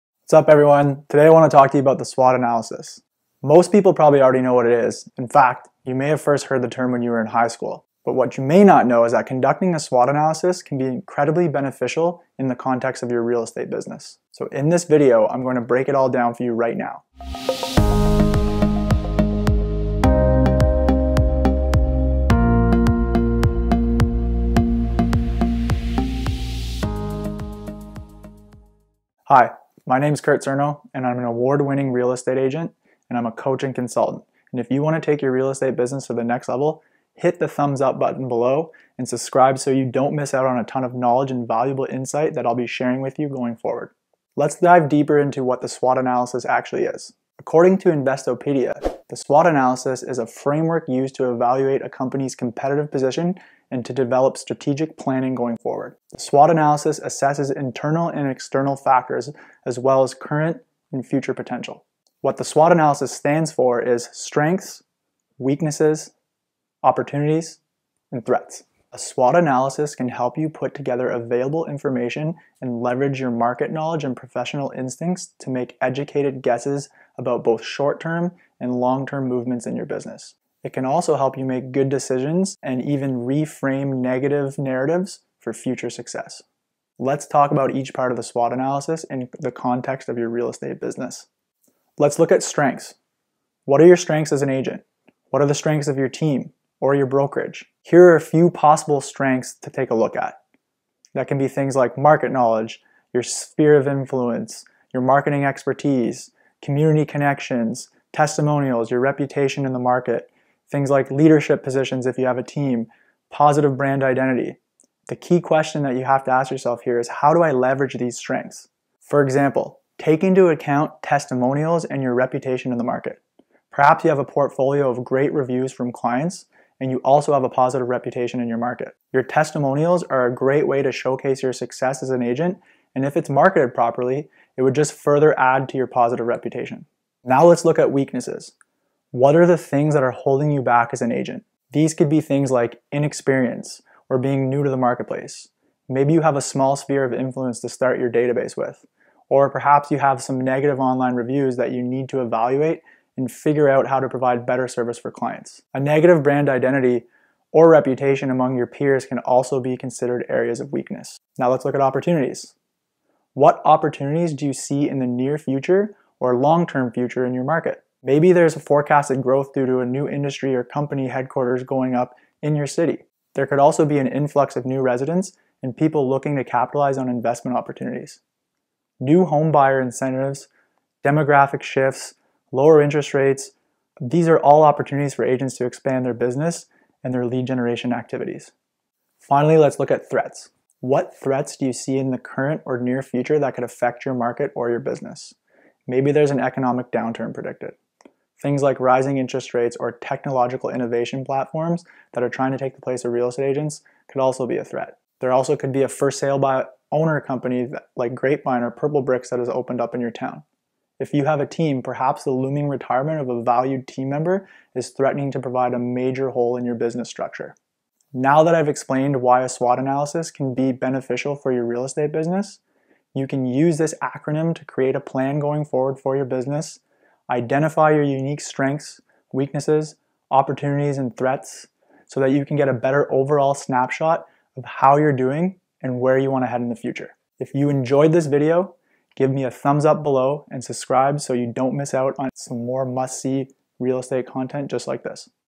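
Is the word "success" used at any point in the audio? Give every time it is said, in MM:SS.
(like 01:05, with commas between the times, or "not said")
01:25, 02:11.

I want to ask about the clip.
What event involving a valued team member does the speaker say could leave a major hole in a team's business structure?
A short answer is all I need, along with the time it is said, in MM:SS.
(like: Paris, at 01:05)
retirement, at 03:32.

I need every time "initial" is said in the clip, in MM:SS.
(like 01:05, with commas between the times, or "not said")
not said.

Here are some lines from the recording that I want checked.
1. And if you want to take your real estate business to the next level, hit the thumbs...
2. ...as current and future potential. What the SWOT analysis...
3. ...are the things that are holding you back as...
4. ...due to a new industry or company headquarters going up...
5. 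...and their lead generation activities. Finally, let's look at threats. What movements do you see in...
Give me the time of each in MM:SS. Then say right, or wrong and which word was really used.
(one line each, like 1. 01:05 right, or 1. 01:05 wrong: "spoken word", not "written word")
1. 00:34 right
2. 01:00 right
3. 02:19 right
4. 02:49 right
5. 03:07 wrong: "threats", not "movements".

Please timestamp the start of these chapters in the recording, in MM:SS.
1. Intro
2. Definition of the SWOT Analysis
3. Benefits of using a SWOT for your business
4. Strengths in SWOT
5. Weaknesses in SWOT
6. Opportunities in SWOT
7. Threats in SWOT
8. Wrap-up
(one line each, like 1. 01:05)
1. 00:17
2. 00:47
3. 01:09
4. 01:32
5. 02:18
6. 02:42
7. 03:10
8. 03:38.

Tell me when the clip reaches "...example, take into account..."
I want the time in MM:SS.
01:59.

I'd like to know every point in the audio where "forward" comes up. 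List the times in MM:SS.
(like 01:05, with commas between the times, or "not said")
00:43, 00:55, 03:45.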